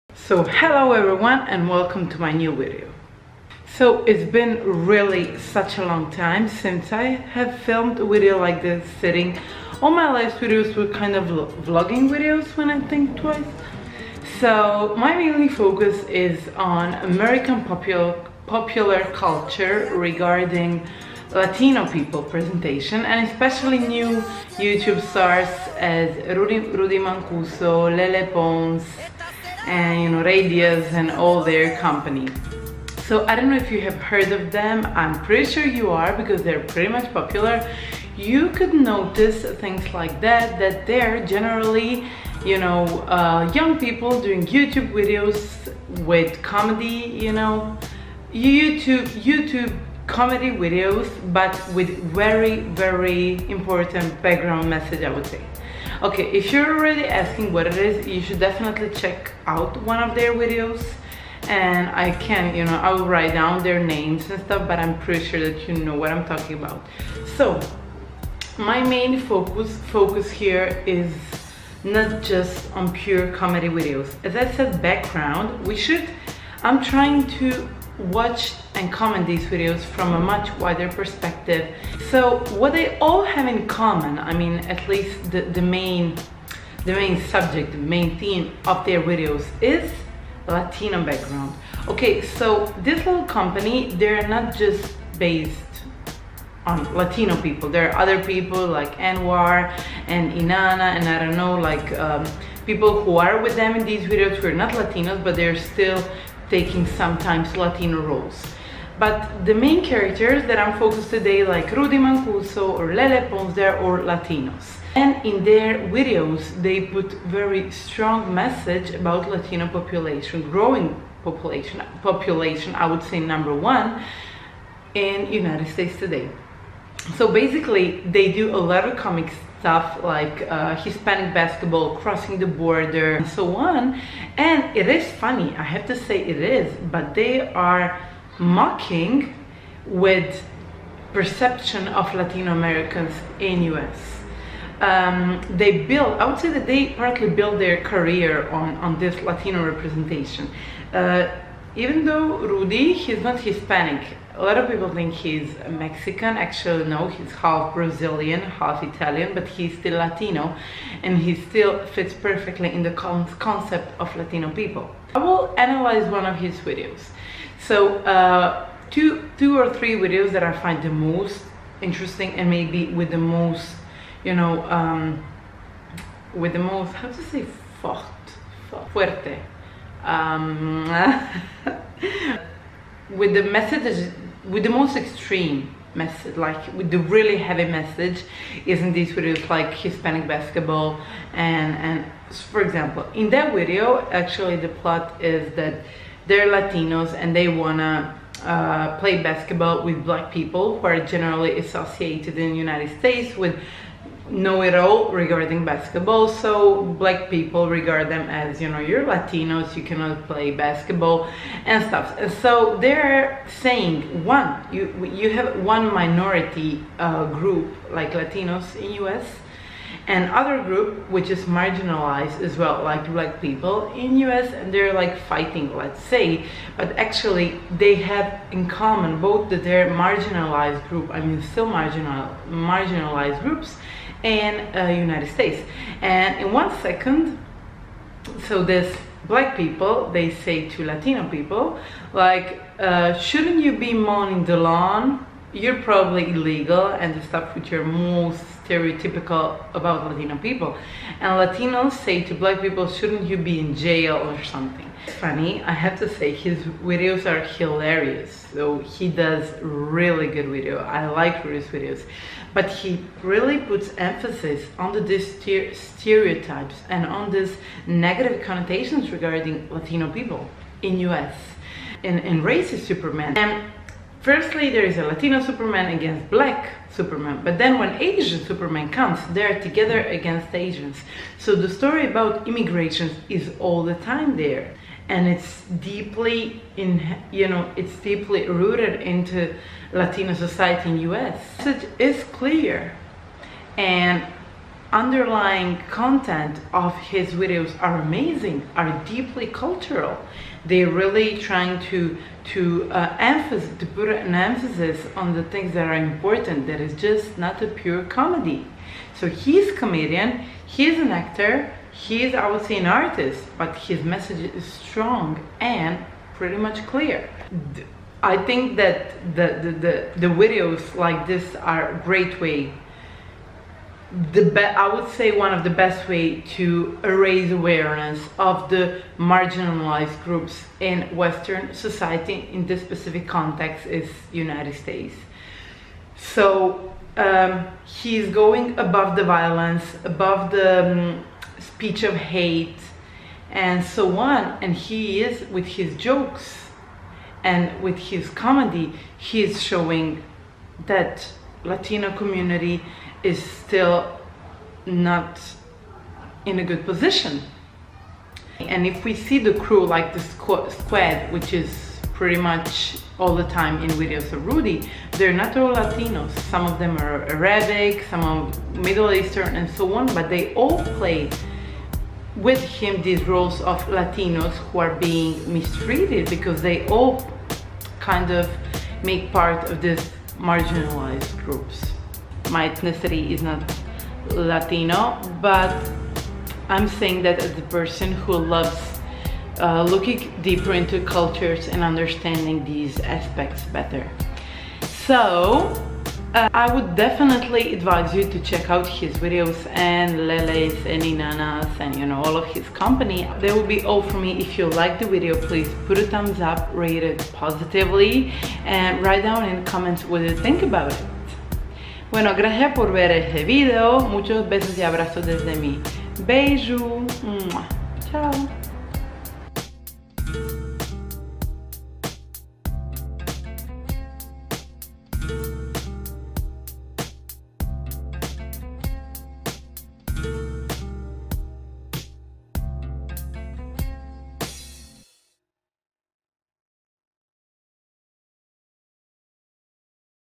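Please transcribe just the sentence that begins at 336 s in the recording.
So um, he is going above the violence, above the um, speech of hate, and so on.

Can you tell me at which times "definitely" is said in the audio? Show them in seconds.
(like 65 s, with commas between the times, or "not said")
58 s, 396 s.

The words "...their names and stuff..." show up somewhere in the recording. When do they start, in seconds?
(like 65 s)
63 s.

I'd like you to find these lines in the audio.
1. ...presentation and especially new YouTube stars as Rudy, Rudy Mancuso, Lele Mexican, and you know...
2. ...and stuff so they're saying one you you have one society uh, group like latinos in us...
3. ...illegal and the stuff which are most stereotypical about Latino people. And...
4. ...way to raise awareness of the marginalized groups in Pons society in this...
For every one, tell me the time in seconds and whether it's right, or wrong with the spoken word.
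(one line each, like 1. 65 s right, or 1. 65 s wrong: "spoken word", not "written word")
1. 22 s wrong: "Pons", not "Mexican"
2. 211 s wrong: "minority", not "society"
3. 246 s right
4. 326 s wrong: "Western", not "Pons".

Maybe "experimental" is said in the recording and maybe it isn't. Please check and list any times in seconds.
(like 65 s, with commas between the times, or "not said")
not said.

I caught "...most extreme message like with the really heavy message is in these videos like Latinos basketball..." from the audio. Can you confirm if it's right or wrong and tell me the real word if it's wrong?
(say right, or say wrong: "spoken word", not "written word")
wrong: "Hispanic", not "Latinos".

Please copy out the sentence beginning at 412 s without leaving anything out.
Bueno, gracias por ver este video.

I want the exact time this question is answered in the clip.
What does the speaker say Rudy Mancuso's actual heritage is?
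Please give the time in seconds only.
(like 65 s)
157 s.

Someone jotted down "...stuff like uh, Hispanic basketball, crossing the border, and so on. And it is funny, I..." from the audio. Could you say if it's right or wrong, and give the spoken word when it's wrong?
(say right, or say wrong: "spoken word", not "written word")
right.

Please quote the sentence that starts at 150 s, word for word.
Uh, even though Rudy, he's not Hispanic.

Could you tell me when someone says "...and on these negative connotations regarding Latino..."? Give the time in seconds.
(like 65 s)
266 s.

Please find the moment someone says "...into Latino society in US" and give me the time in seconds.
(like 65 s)
289 s.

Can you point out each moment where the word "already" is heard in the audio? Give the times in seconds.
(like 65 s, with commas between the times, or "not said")
56 s.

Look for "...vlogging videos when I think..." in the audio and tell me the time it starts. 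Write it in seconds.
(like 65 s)
11 s.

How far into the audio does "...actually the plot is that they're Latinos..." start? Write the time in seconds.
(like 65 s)
194 s.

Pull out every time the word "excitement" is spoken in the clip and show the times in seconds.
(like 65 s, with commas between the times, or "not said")
not said.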